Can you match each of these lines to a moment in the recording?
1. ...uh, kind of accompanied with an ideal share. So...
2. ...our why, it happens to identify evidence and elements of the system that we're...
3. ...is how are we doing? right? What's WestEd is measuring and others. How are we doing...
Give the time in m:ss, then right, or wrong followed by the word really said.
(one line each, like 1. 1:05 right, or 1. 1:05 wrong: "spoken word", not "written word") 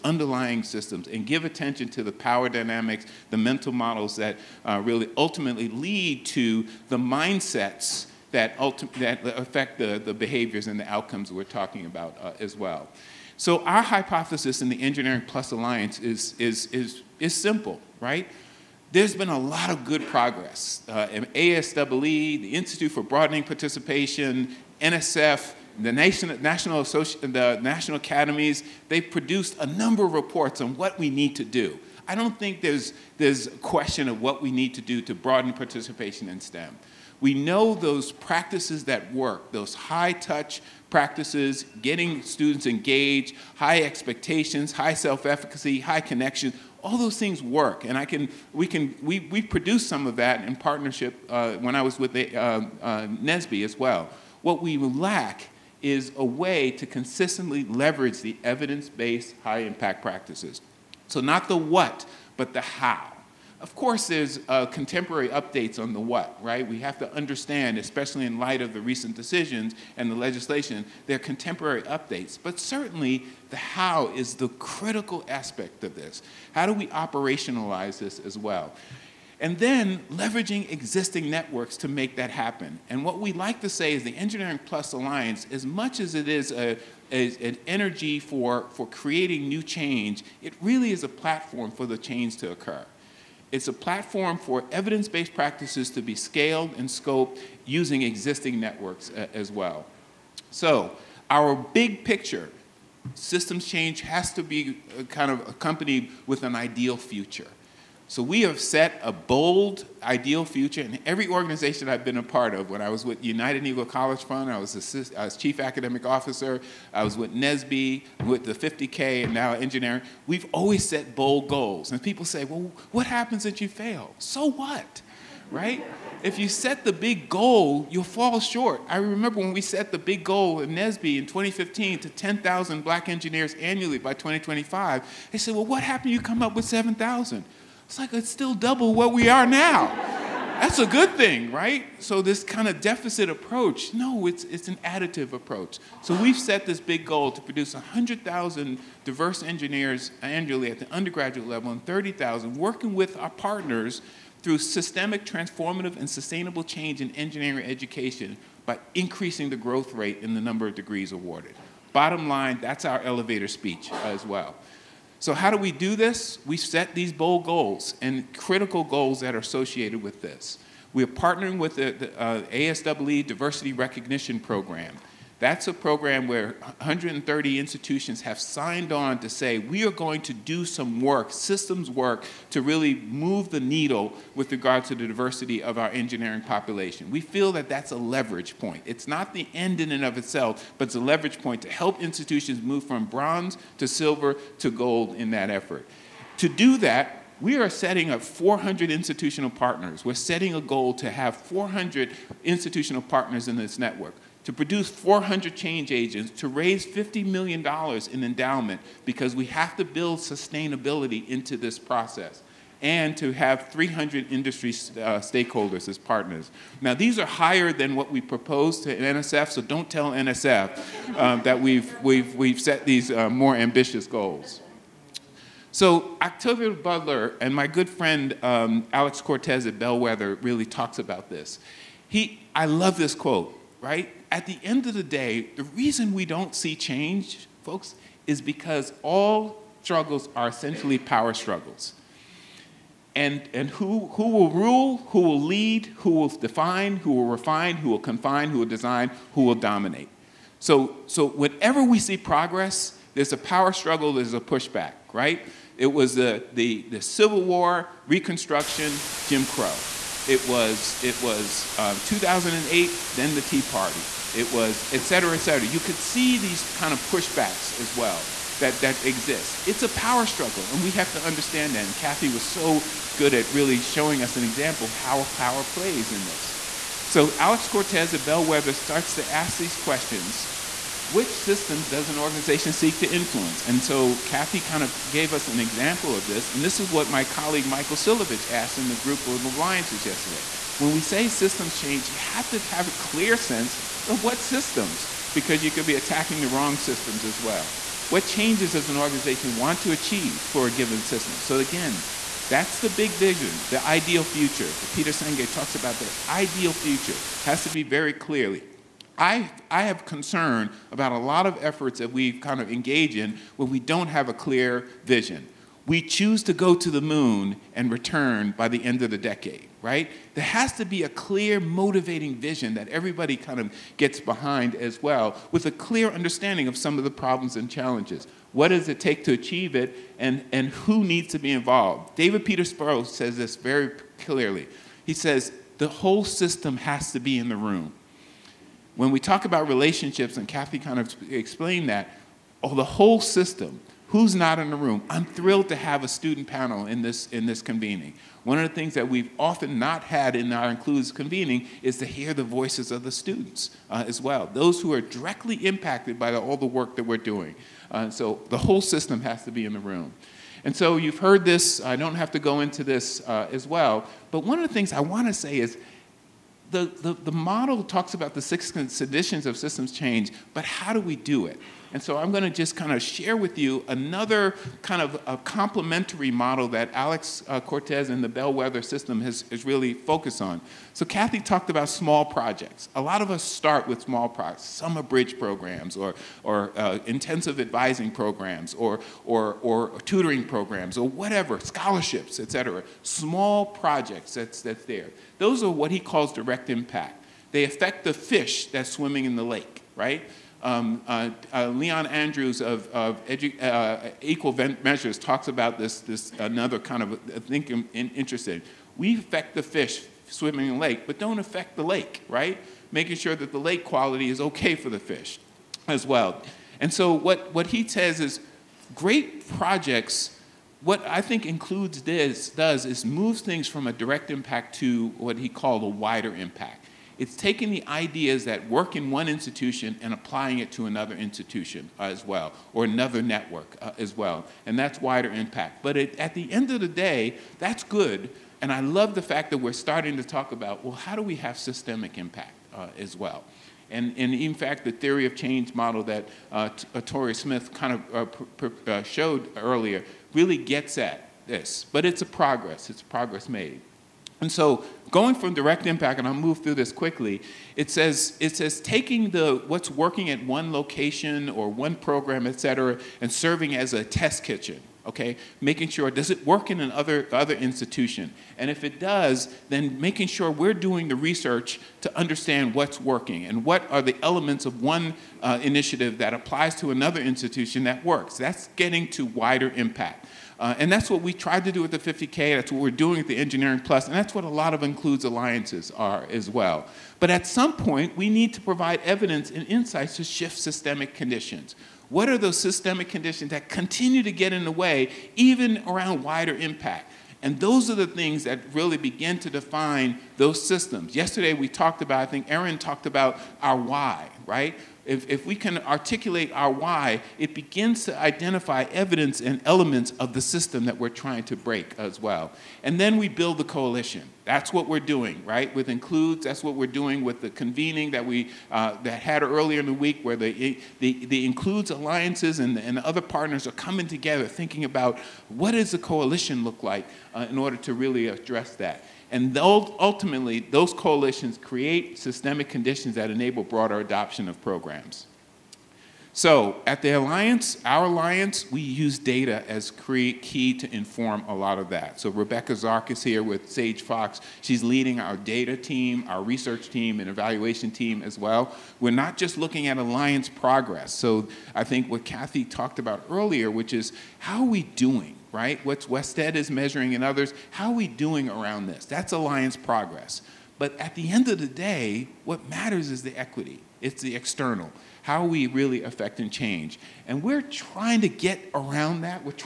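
1. 1:44 wrong: "future", not "share"
2. 8:26 wrong: "begins", not "happens"
3. 9:13 right.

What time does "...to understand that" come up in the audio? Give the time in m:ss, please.
4:31.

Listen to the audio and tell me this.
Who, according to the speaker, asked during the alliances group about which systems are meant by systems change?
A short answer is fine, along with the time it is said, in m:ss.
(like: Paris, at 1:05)
Michael Silovich, at 4:47.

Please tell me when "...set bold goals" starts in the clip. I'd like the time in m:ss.
2:00.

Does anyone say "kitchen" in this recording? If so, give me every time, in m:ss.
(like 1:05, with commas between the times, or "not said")
7:44.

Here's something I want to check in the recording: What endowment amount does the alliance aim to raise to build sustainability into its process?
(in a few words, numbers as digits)
$50 million.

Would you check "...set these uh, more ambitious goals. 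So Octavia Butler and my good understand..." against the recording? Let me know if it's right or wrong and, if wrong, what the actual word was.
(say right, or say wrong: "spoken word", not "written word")
wrong: "friend", not "understand".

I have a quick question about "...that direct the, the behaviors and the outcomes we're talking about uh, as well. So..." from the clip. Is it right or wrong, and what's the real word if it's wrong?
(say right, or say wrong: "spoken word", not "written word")
wrong: "affect", not "direct".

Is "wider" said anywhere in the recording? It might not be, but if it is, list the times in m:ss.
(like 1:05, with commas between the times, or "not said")
7:05, 7:15, 7:59, 8:16.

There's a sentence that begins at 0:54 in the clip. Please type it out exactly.
What we lack is a way to consistently leverage the evidence-based high-impact practices.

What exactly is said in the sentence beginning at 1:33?
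It's a platform for evidence-based practices to be scaled and scoped using existing networks uh, as well.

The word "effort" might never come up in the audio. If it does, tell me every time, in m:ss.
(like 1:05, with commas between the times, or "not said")
3:15, 5:11.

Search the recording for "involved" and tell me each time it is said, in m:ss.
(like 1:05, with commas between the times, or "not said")
5:31.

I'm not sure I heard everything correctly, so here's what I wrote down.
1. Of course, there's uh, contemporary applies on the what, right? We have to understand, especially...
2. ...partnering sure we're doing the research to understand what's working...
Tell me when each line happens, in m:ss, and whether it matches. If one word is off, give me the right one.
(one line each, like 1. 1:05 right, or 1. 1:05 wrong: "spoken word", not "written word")
1. 1:03 wrong: "updates", not "applies"
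2. 7:49 wrong: "making", not "partnering".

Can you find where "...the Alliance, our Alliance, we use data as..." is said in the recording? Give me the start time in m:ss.
8:57.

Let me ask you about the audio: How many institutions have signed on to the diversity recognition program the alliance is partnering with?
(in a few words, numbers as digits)
130.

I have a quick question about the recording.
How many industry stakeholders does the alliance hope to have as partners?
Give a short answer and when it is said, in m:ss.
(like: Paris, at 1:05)
300, at 3:33.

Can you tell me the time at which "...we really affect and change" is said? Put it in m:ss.
9:25.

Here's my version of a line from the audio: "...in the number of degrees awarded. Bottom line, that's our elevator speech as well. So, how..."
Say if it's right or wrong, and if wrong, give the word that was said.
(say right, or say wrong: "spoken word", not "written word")
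right.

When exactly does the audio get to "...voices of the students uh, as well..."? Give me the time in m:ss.
5:52.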